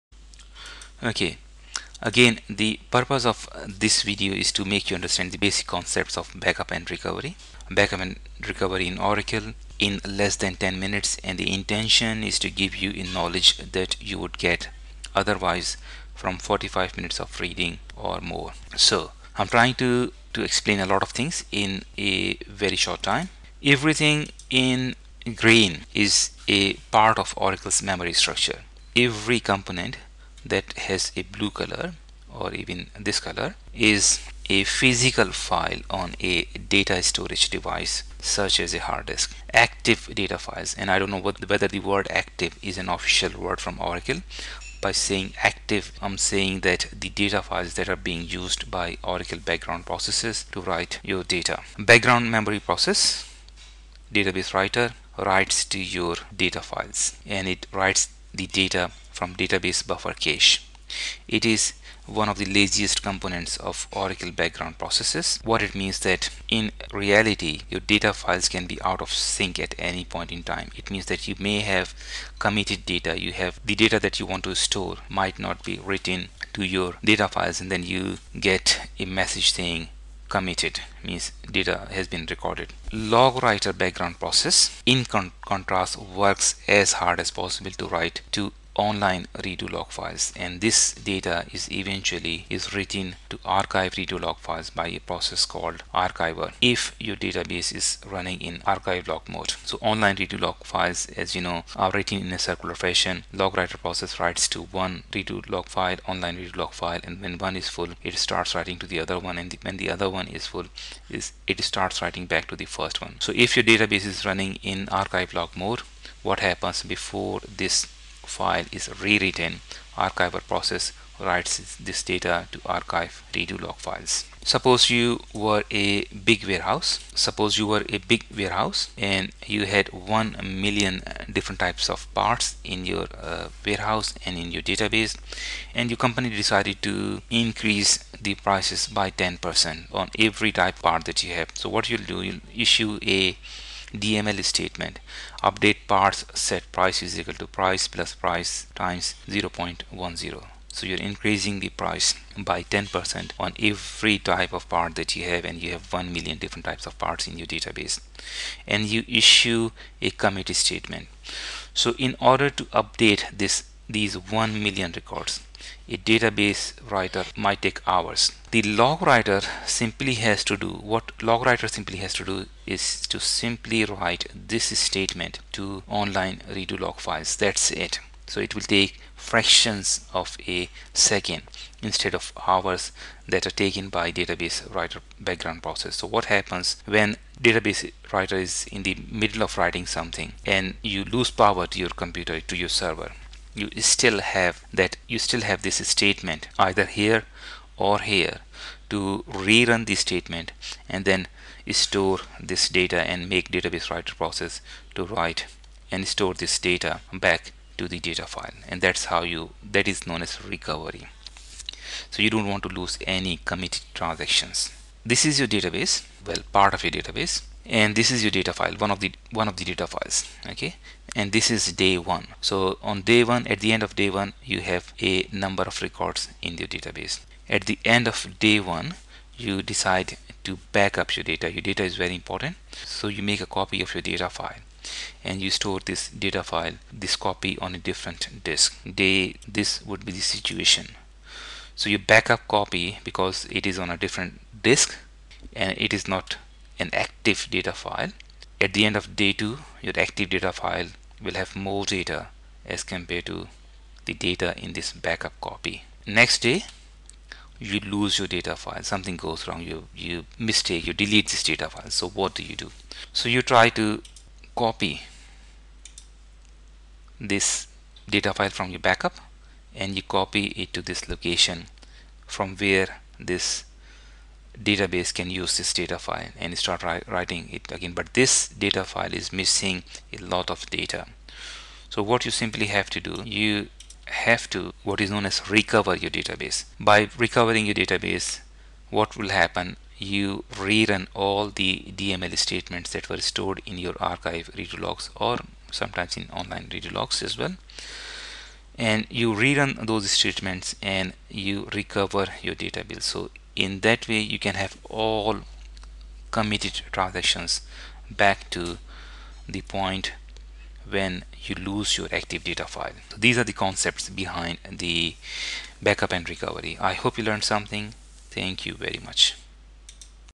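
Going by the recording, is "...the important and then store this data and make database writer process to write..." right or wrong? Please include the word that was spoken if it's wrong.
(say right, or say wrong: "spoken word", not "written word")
wrong: "statement", not "important".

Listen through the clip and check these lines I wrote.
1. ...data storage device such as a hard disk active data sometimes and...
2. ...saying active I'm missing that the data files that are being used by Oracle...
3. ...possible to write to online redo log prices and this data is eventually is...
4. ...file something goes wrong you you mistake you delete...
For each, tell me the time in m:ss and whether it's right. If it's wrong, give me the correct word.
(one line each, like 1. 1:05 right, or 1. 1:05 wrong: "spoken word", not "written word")
1. 0:36 wrong: "files", not "sometimes"
2. 0:44 wrong: "saying", not "missing"
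3. 1:27 wrong: "files", not "prices"
4. 4:18 right.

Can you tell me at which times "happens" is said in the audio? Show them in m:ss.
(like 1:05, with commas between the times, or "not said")
1:56, 3:06, 4:49.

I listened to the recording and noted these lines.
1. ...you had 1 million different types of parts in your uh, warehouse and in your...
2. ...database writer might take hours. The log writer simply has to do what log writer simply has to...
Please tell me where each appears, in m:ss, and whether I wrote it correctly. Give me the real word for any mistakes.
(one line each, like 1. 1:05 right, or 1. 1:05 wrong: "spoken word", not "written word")
1. 2:09 right
2. 2:45 right.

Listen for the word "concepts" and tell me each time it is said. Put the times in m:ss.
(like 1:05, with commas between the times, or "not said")
0:05, 5:13.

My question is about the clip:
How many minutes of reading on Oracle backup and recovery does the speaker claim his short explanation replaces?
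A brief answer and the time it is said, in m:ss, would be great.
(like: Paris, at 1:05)
45, at 0:16.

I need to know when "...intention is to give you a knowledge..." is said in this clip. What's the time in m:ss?
0:11.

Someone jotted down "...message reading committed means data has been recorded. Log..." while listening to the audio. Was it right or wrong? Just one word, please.
wrong.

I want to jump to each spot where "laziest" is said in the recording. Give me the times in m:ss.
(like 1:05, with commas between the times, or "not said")
1:02.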